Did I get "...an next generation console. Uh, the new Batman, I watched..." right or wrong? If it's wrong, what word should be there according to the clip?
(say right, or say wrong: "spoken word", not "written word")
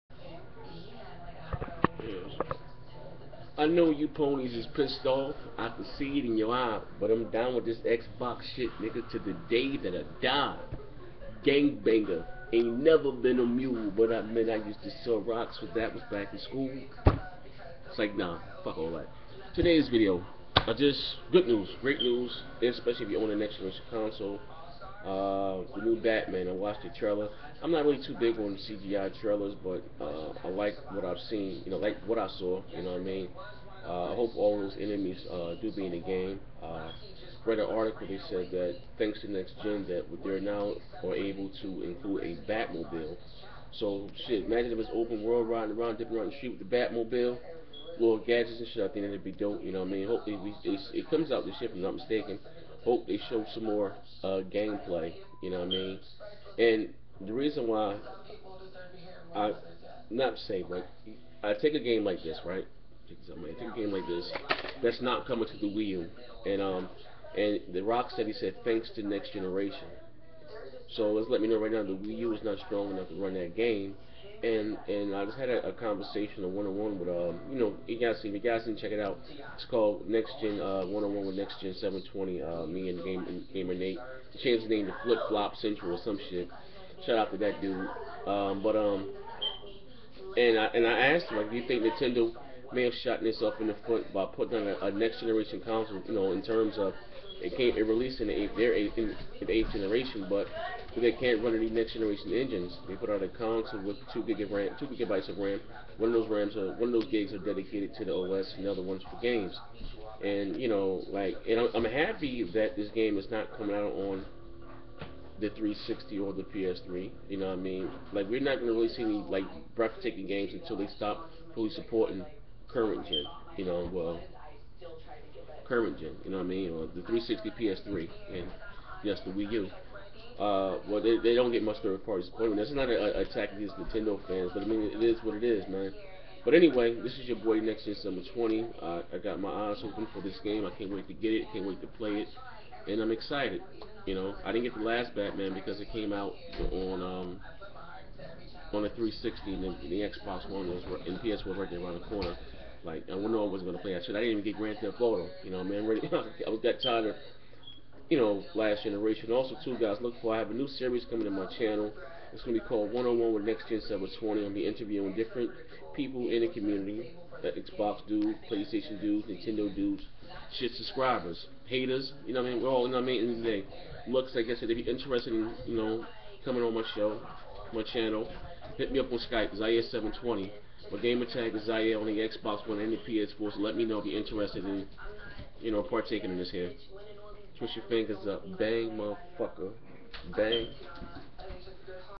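right.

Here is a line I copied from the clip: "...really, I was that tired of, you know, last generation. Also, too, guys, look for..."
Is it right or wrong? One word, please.
right.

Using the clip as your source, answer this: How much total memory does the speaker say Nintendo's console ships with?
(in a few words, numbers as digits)
2 gigabytes.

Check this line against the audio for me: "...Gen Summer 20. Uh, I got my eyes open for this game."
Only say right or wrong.
right.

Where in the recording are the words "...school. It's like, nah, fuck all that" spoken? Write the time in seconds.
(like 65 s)
16 s.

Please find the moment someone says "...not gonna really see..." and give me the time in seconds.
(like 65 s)
118 s.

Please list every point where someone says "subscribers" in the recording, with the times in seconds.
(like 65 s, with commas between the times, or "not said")
170 s.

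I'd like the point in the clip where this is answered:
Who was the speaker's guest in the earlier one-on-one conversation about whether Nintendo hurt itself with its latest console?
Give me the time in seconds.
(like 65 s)
83 s.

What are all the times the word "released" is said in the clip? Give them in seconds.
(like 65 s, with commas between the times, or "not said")
97 s.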